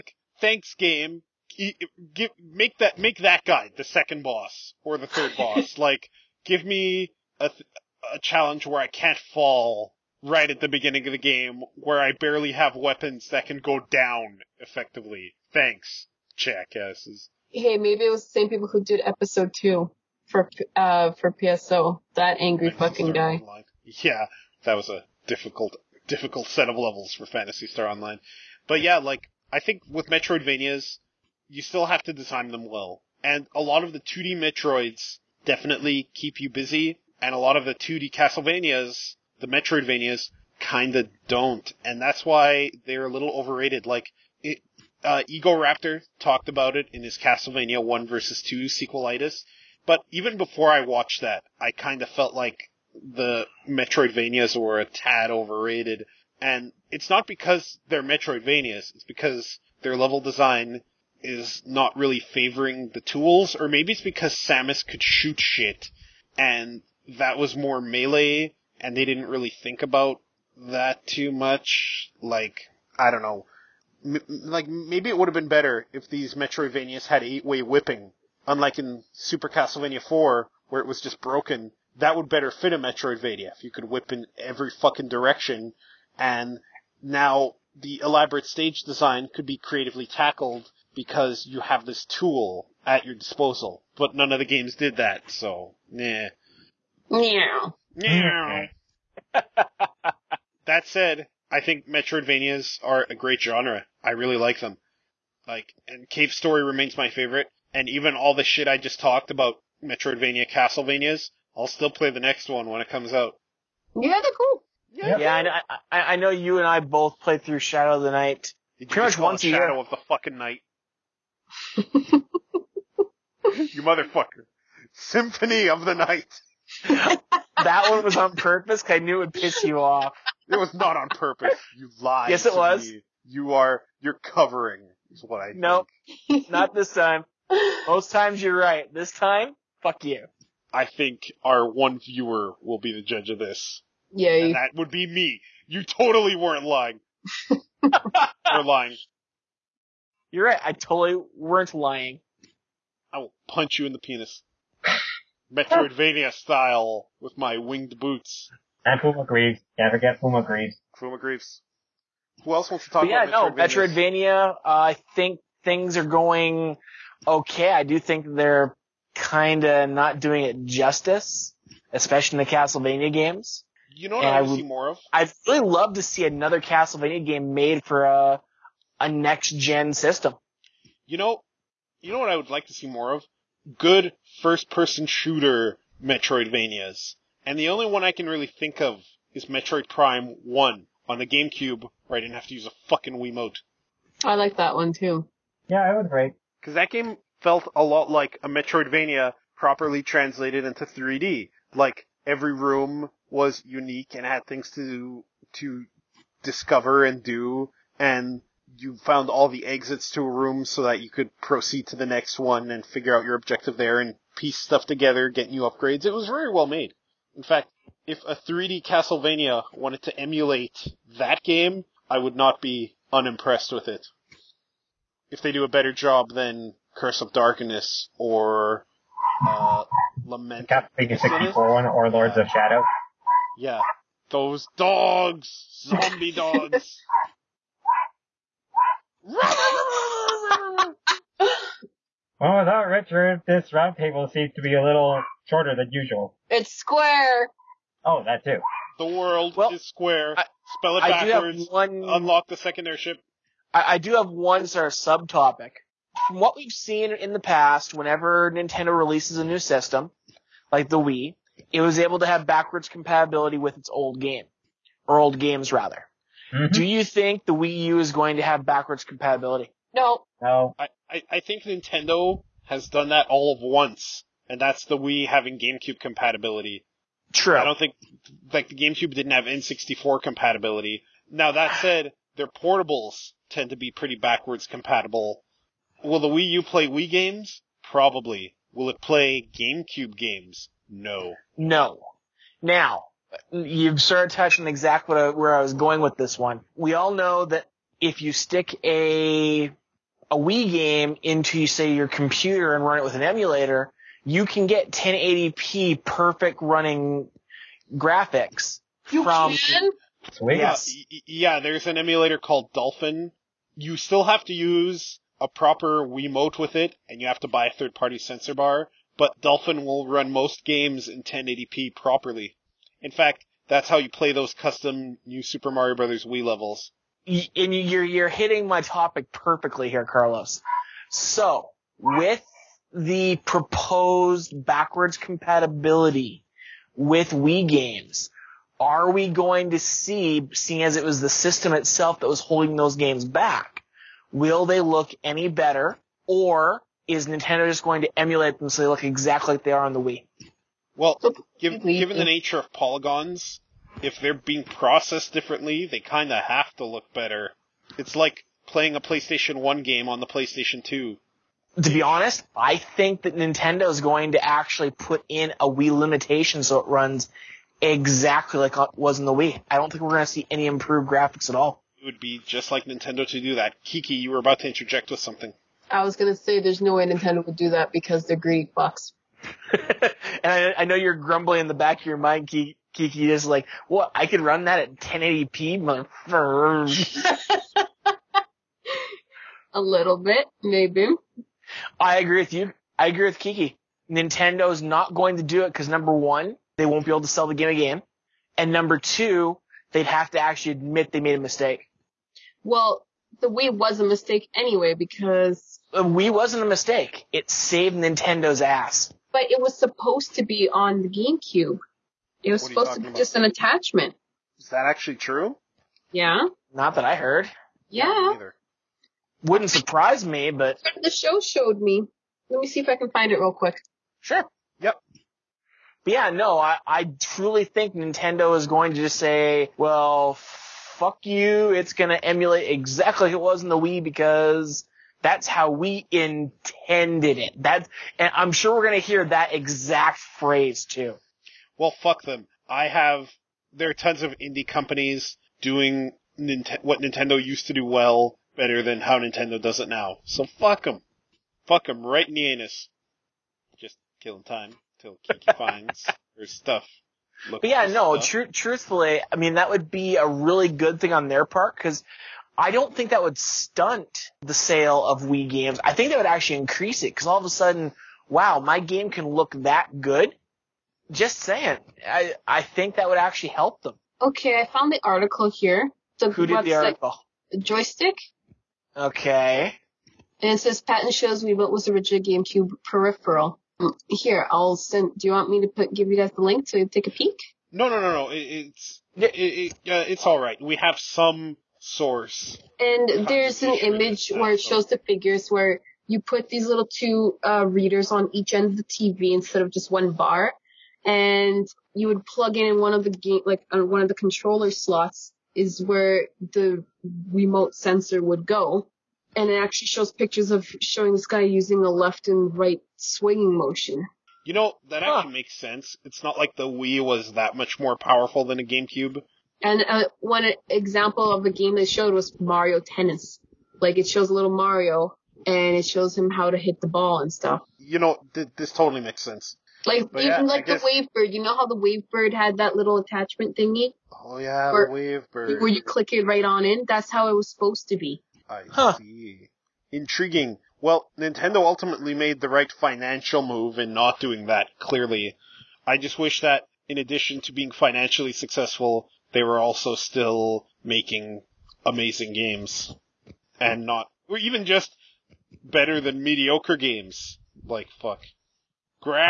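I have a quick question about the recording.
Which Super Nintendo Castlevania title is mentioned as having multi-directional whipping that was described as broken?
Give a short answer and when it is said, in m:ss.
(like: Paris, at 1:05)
Super Castlevania 4, at 1:19.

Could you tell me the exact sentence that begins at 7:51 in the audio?
Just saying, I I think that would actually help them.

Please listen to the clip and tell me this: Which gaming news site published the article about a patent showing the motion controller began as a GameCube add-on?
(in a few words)
Joystiq.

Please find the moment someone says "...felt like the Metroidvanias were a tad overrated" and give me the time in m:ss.
0:52.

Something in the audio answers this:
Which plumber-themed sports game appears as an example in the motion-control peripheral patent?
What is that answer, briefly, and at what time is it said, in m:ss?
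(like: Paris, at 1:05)
Mario Tennis, at 8:42.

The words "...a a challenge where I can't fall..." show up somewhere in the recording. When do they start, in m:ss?
0:07.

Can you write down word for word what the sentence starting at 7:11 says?
It's going to emulate exactly like it was in the Wii because that's how we intended it.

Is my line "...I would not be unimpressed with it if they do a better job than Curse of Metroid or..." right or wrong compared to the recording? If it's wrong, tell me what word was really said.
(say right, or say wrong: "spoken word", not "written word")
wrong: "Darkness", not "Metroid".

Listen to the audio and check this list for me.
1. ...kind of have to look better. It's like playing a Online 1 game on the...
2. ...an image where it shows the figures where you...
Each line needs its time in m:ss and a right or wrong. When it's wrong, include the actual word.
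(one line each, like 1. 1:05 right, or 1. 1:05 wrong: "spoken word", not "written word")
1. 5:55 wrong: "PlayStation", not "Online"
2. 8:13 right.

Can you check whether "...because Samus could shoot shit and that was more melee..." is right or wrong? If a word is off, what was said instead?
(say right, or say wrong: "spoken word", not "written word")
right.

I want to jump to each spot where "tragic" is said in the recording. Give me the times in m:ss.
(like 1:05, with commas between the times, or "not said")
not said.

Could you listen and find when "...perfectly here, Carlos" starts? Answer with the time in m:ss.
5:29.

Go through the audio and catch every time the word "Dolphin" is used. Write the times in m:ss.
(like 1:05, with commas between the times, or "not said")
5:12, 5:19.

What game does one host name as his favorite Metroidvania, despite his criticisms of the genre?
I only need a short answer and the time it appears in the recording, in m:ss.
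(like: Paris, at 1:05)
Cave Story, at 1:46.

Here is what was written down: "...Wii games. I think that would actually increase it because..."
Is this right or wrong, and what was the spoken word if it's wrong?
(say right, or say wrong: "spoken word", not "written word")
right.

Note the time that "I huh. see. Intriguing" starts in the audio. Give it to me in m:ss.
8:58.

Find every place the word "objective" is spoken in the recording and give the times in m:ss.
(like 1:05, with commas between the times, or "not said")
3:33.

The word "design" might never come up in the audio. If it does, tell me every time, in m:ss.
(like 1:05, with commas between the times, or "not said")
0:32, 1:00, 1:28.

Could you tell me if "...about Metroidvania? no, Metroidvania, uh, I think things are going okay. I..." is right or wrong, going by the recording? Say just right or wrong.
right.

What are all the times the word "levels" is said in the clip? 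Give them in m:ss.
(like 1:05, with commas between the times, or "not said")
0:26, 0:59, 5:26.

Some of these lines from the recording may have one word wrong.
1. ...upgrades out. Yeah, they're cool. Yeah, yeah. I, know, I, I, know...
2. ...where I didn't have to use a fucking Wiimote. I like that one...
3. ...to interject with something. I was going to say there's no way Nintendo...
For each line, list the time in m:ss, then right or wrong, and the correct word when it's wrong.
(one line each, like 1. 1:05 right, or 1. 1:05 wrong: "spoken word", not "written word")
1. 1:52 wrong: "comes", not "upgrades"
2. 3:12 right
3. 6:14 right.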